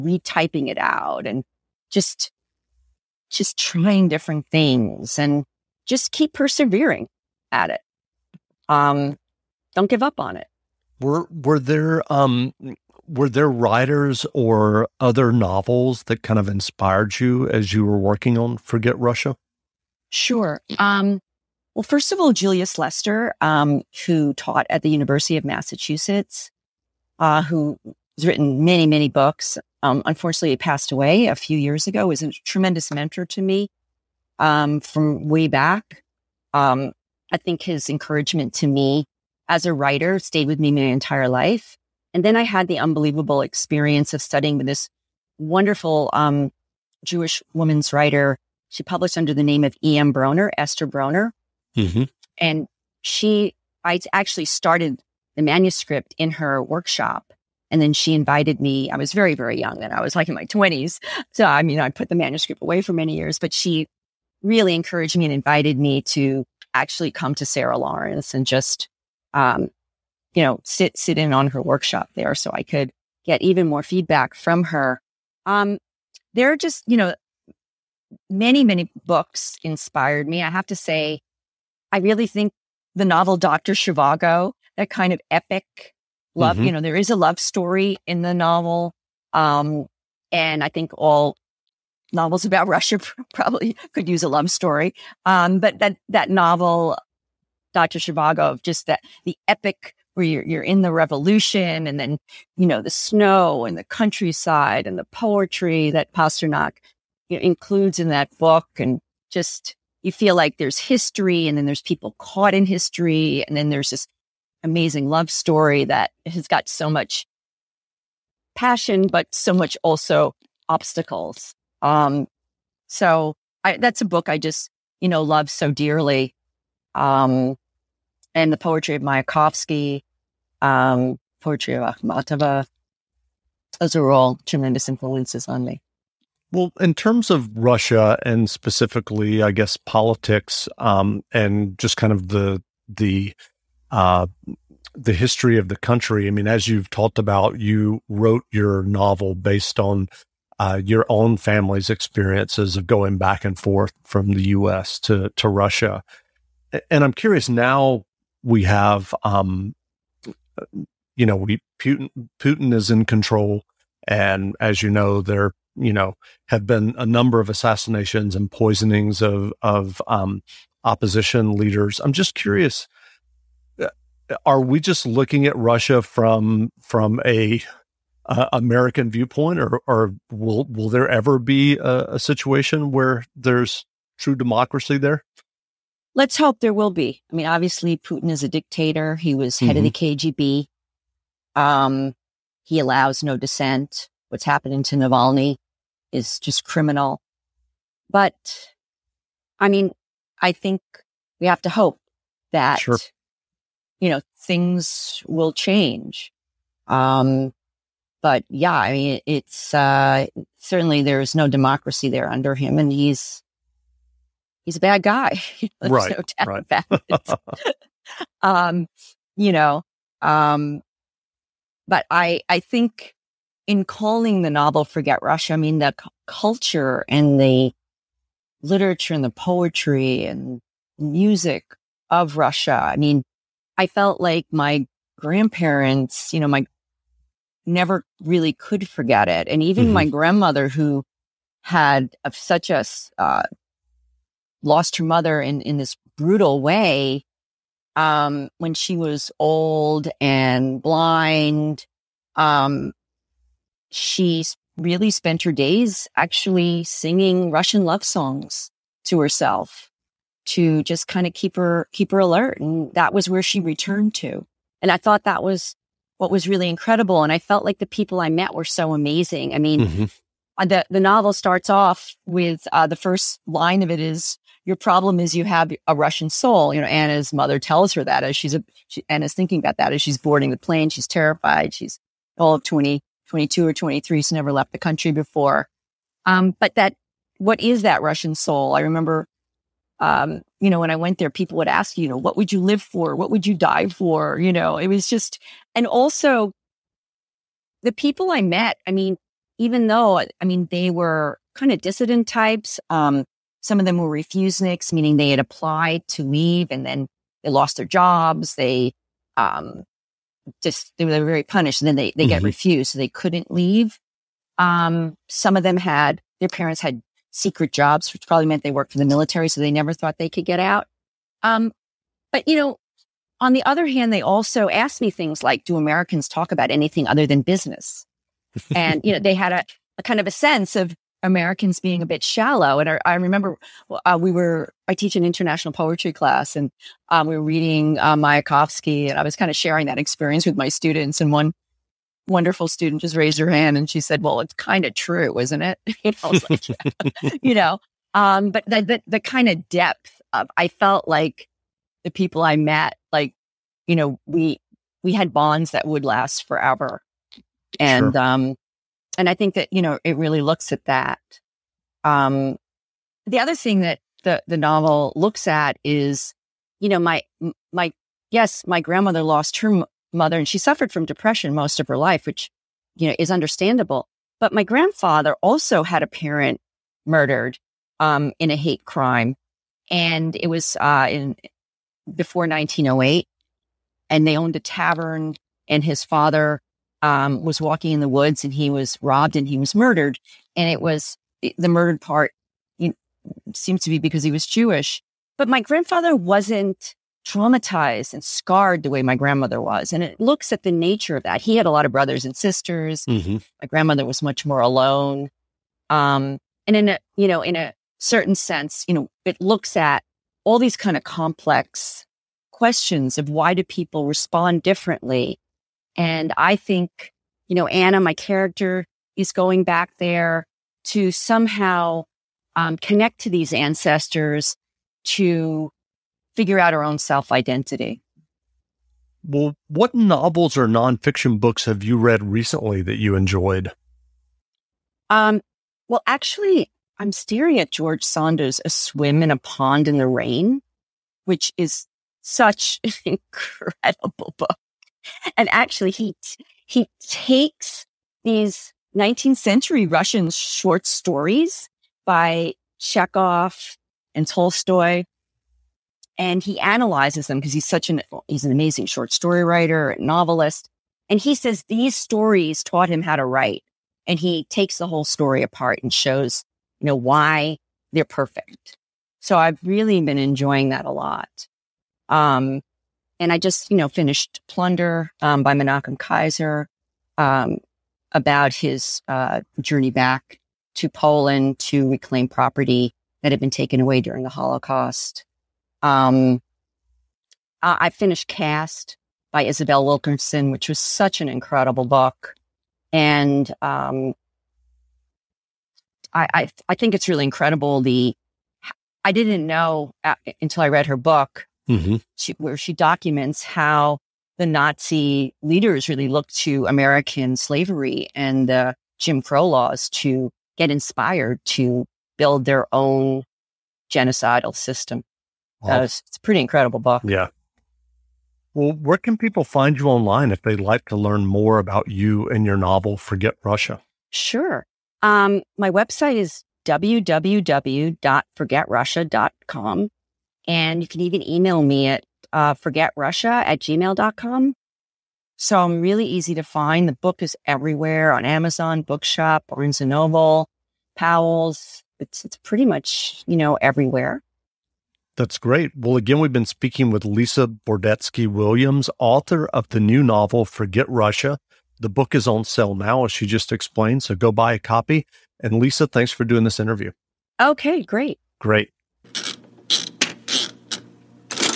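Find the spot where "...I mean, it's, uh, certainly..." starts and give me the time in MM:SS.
03:28.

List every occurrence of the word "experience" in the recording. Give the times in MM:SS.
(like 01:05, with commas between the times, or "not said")
00:43, 02:31, 05:39.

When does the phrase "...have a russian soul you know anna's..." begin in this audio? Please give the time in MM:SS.
04:35.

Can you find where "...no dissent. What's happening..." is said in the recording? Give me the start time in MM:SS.
03:13.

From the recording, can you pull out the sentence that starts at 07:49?
So I've really been enjoying that a lot.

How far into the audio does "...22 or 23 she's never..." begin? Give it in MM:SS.
04:43.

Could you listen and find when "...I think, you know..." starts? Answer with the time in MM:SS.
06:56.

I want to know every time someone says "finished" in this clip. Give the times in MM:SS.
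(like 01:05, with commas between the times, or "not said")
07:53, 08:07.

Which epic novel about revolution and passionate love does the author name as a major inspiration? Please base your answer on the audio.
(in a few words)
Dr. Zhivago.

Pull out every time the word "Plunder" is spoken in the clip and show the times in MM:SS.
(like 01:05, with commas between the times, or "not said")
07:54.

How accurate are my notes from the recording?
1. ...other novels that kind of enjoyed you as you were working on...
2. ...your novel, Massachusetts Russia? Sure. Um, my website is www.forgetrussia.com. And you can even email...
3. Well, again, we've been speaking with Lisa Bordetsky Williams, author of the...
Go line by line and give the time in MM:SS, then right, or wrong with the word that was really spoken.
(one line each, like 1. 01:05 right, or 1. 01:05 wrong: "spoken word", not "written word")
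1. 00:14 wrong: "inspired", not "enjoyed"
2. 08:42 wrong: "Forget", not "Massachusetts"
3. 09:05 right.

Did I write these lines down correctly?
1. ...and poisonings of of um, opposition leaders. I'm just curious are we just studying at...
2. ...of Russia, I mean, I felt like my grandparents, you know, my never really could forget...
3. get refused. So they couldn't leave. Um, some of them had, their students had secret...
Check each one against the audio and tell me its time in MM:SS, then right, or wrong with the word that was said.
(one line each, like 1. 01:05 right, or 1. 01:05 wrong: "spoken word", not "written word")
1. 02:48 wrong: "looking", not "studying"
2. 03:52 right
3. 05:12 wrong: "parents", not "students".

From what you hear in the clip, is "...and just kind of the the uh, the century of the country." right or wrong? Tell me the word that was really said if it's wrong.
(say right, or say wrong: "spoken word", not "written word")
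wrong: "history", not "century".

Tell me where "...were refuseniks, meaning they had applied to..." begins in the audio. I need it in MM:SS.
05:03.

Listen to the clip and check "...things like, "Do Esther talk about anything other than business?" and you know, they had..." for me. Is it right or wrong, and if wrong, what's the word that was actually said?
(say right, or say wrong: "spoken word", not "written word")
wrong: "Americans", not "Esther".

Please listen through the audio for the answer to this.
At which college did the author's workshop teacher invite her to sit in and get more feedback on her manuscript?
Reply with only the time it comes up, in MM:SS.
01:07.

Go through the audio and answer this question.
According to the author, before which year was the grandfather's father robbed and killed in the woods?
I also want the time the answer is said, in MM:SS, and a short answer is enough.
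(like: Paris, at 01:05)
1908, at 06:22.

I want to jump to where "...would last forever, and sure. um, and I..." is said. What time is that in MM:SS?
05:55.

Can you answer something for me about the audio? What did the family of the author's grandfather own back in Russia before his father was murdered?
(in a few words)
a tavern.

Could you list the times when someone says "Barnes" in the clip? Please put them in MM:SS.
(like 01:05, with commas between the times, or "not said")
08:59.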